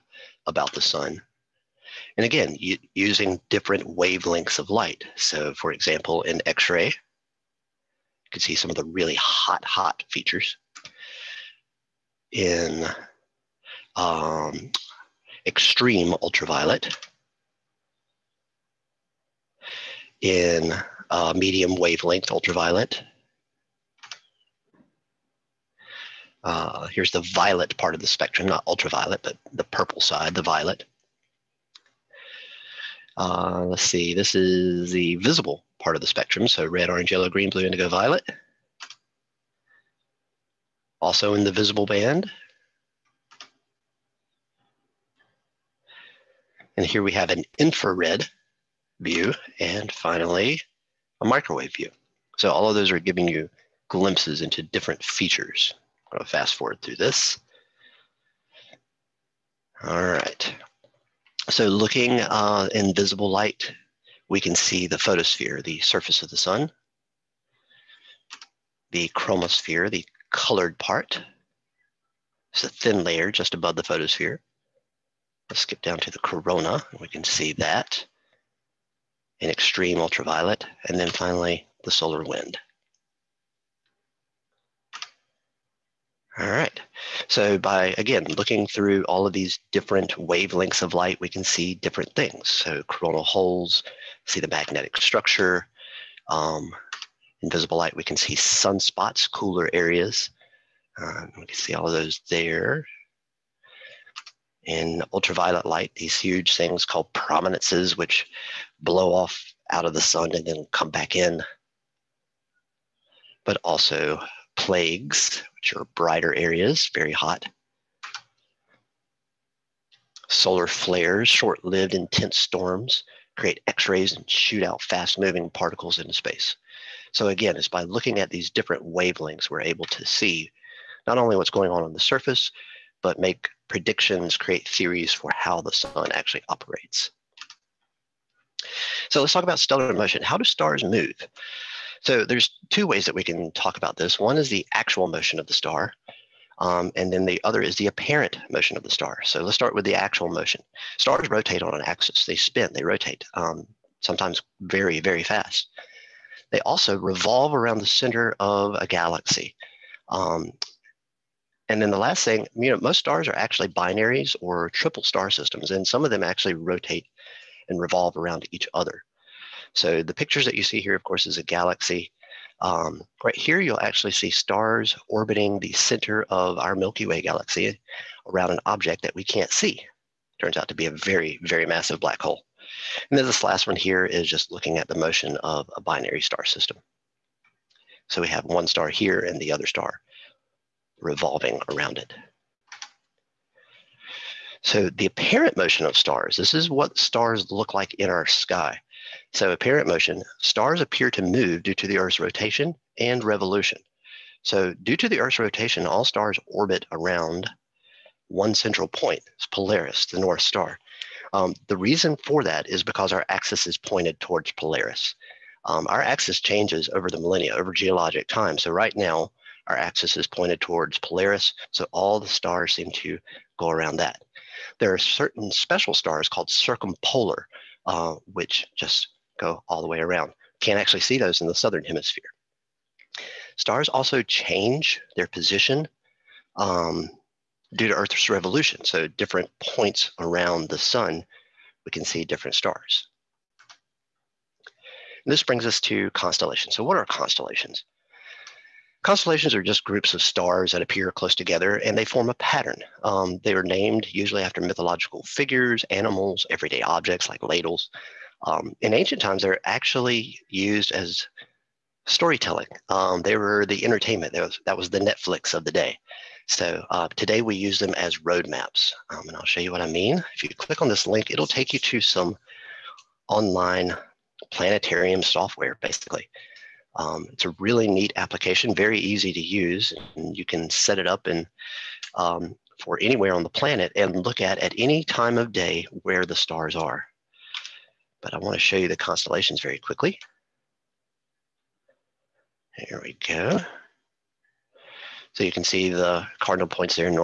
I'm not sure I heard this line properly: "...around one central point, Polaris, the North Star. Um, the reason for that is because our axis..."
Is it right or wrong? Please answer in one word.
right.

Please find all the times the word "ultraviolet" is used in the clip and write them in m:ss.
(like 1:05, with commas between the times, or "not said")
0:16, 0:22, 0:28, 1:19, 1:45.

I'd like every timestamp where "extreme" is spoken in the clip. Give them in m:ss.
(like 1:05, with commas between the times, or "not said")
0:15, 1:19.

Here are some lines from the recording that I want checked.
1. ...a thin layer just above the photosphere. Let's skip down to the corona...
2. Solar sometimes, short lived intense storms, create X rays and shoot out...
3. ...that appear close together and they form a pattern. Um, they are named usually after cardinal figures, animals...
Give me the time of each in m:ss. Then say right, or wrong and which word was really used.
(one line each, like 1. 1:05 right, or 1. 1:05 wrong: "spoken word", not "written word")
1. 1:12 right
2. 2:00 wrong: "flares", not "sometimes"
3. 4:10 wrong: "mythological", not "cardinal".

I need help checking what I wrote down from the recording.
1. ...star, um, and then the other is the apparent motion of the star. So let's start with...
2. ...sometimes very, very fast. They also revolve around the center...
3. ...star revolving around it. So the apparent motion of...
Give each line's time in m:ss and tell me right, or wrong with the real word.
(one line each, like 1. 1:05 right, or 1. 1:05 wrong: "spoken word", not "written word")
1. 2:25 right
2. 2:33 right
3. 3:09 right.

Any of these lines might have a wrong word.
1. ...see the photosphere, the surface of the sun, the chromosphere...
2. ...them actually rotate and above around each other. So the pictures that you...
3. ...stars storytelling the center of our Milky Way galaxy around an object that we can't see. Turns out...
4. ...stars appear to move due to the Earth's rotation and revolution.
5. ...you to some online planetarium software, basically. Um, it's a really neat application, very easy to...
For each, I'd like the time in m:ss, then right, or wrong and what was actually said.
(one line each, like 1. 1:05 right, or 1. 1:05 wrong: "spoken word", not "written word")
1. 1:04 right
2. 2:46 wrong: "revolve", not "above"
3. 2:54 wrong: "orbiting", not "storytelling"
4. 3:20 right
5. 4:31 right.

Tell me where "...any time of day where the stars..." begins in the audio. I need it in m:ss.
4:44.